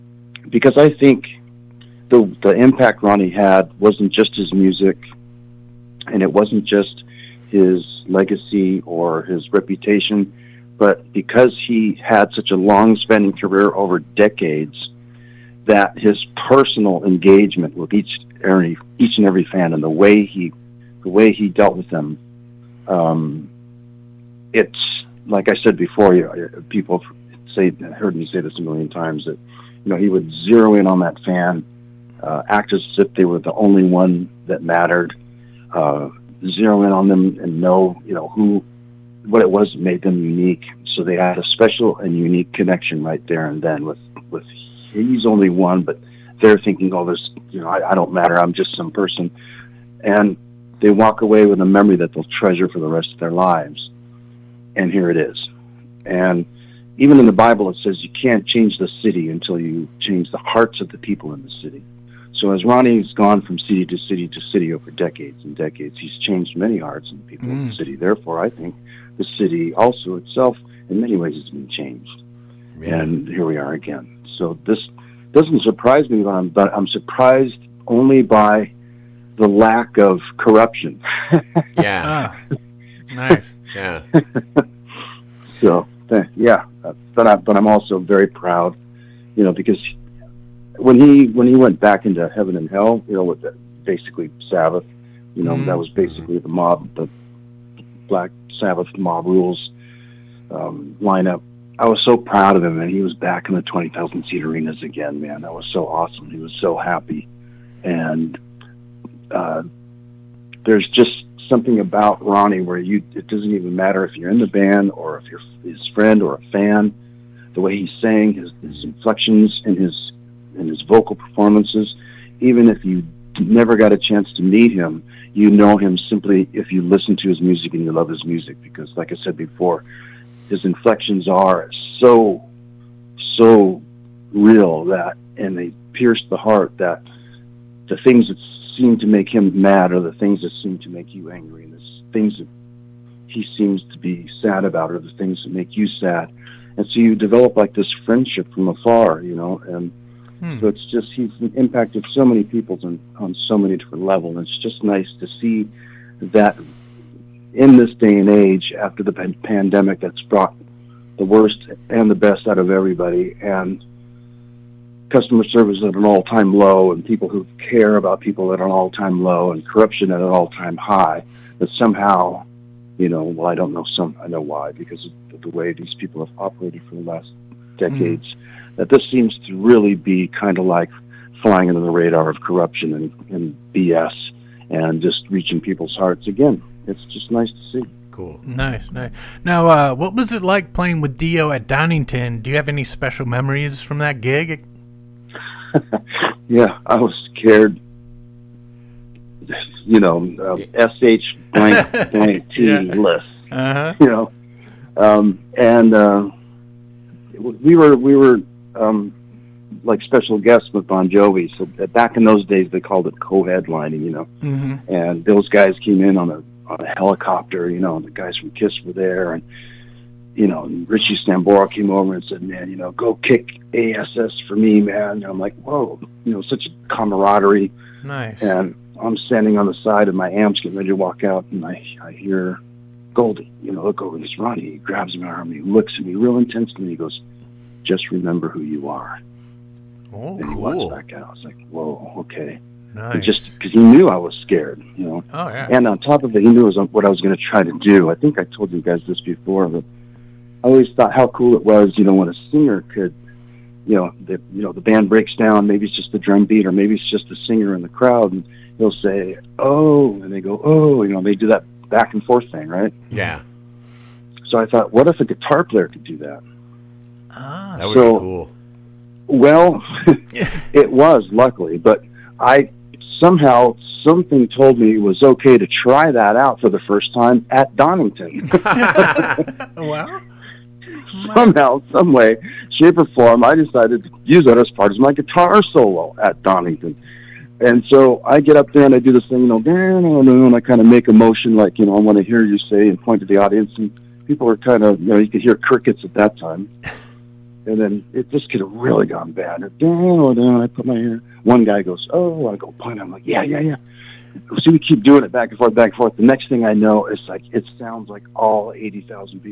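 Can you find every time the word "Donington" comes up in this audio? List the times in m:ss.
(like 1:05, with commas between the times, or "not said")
3:11, 4:37, 4:46.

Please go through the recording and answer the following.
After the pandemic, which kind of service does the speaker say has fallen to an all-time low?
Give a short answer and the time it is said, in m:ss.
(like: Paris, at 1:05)
Customer service, at 2:45.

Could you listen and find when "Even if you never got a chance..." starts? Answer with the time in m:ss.
2:02.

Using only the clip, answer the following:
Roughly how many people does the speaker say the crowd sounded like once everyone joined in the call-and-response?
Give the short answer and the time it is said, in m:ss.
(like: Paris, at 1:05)
80,000, at 5:08.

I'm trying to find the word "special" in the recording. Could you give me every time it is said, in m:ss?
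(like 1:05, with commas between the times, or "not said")
0:41, 3:12, 3:30.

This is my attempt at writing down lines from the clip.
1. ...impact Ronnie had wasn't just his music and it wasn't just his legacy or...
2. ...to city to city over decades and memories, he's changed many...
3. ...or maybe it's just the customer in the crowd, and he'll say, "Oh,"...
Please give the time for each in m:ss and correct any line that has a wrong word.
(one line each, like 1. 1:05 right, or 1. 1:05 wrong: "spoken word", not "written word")
1. 0:02 right
2. 1:03 wrong: "decades", not "memories"
3. 4:16 wrong: "singer", not "customer".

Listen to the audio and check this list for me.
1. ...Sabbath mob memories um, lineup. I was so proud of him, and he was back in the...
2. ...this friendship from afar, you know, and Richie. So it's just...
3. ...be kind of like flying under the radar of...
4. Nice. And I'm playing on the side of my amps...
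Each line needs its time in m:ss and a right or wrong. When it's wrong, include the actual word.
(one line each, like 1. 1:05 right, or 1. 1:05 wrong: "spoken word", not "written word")
1. 1:38 wrong: "rules", not "memories"
2. 2:27 wrong: "Hmm", not "Richie"
3. 2:59 right
4. 3:48 wrong: "standing", not "playing".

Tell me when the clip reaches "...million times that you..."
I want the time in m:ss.
0:28.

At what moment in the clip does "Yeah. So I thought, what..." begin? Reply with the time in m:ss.
4:23.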